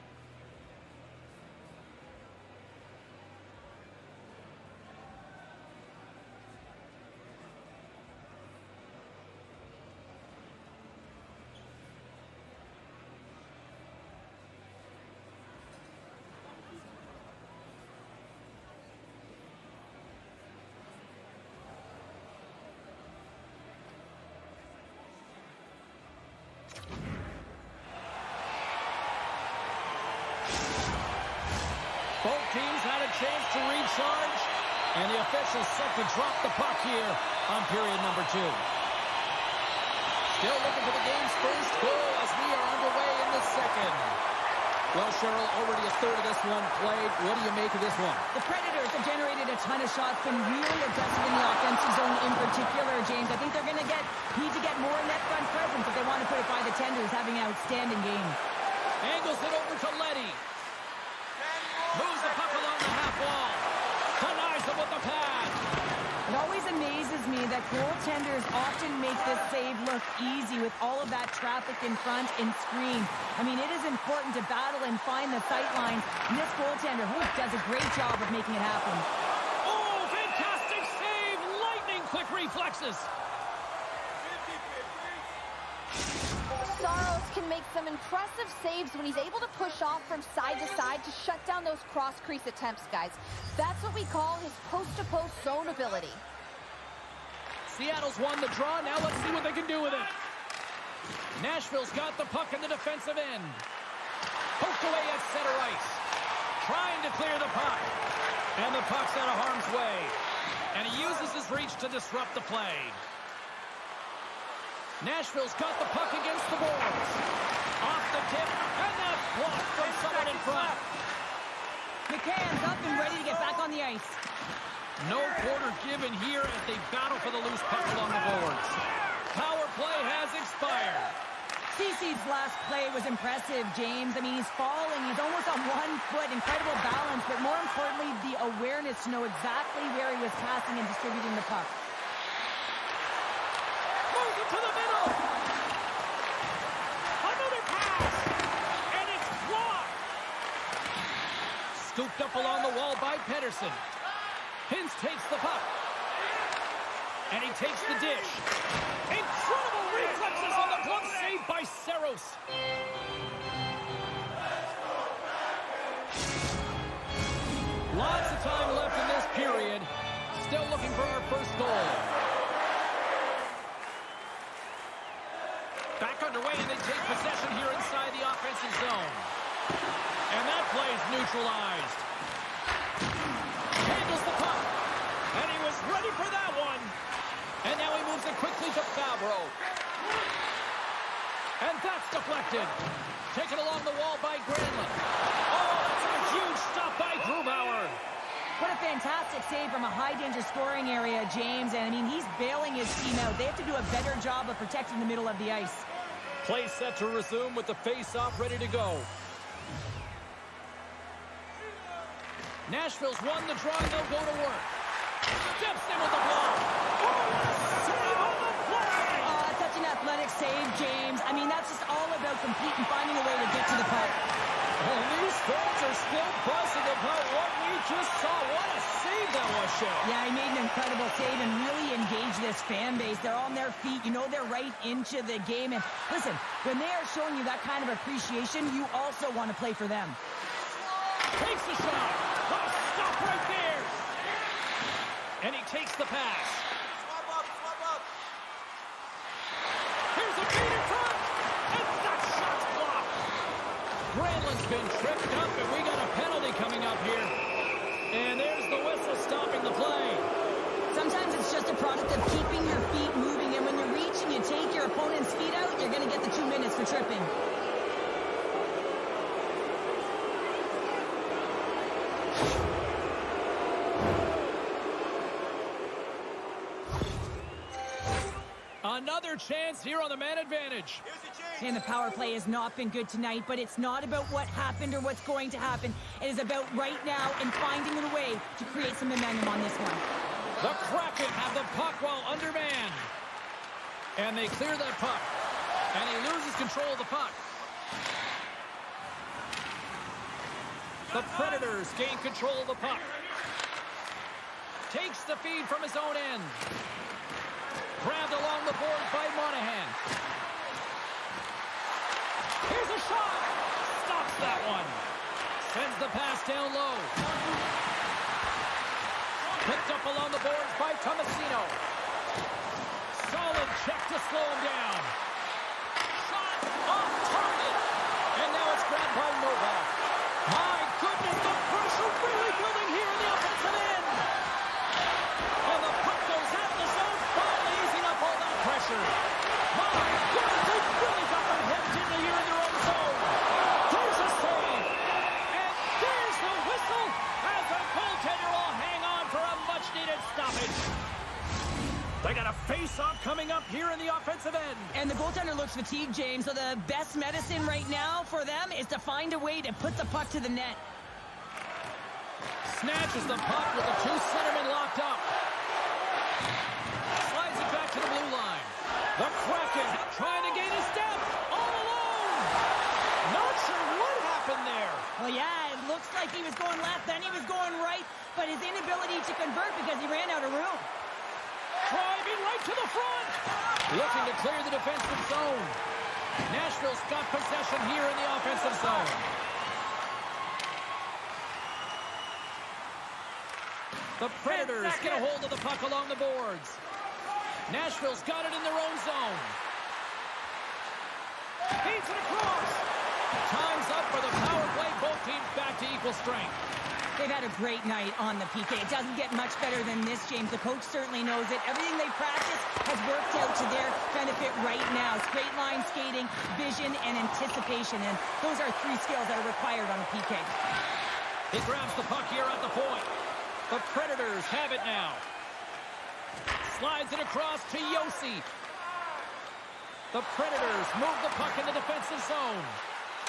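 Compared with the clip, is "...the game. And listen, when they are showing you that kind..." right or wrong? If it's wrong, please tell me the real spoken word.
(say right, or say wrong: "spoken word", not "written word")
right.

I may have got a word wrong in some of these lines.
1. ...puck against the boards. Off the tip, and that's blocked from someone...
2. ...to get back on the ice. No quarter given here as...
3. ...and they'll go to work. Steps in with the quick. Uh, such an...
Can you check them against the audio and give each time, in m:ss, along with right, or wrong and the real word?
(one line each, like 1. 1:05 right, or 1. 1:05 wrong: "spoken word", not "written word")
1. 1:55 right
2. 2:03 right
3. 3:33 wrong: "block", not "quick".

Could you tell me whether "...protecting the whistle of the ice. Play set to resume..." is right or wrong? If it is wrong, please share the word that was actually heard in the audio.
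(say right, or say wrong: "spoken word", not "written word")
wrong: "middle", not "whistle".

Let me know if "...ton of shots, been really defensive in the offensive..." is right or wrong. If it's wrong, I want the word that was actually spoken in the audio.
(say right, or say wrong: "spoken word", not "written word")
wrong: "aggressive", not "defensive".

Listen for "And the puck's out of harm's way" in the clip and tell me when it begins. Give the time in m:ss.
1:48.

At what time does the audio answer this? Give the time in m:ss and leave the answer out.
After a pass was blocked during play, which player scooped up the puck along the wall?
2:33.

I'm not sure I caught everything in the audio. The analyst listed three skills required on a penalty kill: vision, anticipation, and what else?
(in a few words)
Straight line skating.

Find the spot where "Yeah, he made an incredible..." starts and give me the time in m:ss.
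3:50.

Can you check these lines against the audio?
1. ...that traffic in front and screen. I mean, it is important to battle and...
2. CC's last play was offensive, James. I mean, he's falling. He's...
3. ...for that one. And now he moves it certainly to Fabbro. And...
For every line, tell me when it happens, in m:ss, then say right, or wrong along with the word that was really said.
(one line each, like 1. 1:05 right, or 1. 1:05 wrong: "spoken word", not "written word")
1. 1:11 right
2. 2:11 wrong: "impressive", not "offensive"
3. 3:06 wrong: "quickly", not "certainly".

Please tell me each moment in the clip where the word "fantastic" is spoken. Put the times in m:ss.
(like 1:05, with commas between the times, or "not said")
1:20, 3:18.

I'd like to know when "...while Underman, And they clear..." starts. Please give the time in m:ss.
4:52.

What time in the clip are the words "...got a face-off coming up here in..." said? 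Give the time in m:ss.
5:52.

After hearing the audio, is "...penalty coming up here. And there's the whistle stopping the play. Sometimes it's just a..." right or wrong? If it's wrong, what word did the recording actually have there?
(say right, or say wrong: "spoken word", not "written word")
right.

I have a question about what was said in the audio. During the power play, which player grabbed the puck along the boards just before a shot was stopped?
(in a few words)
Monahan.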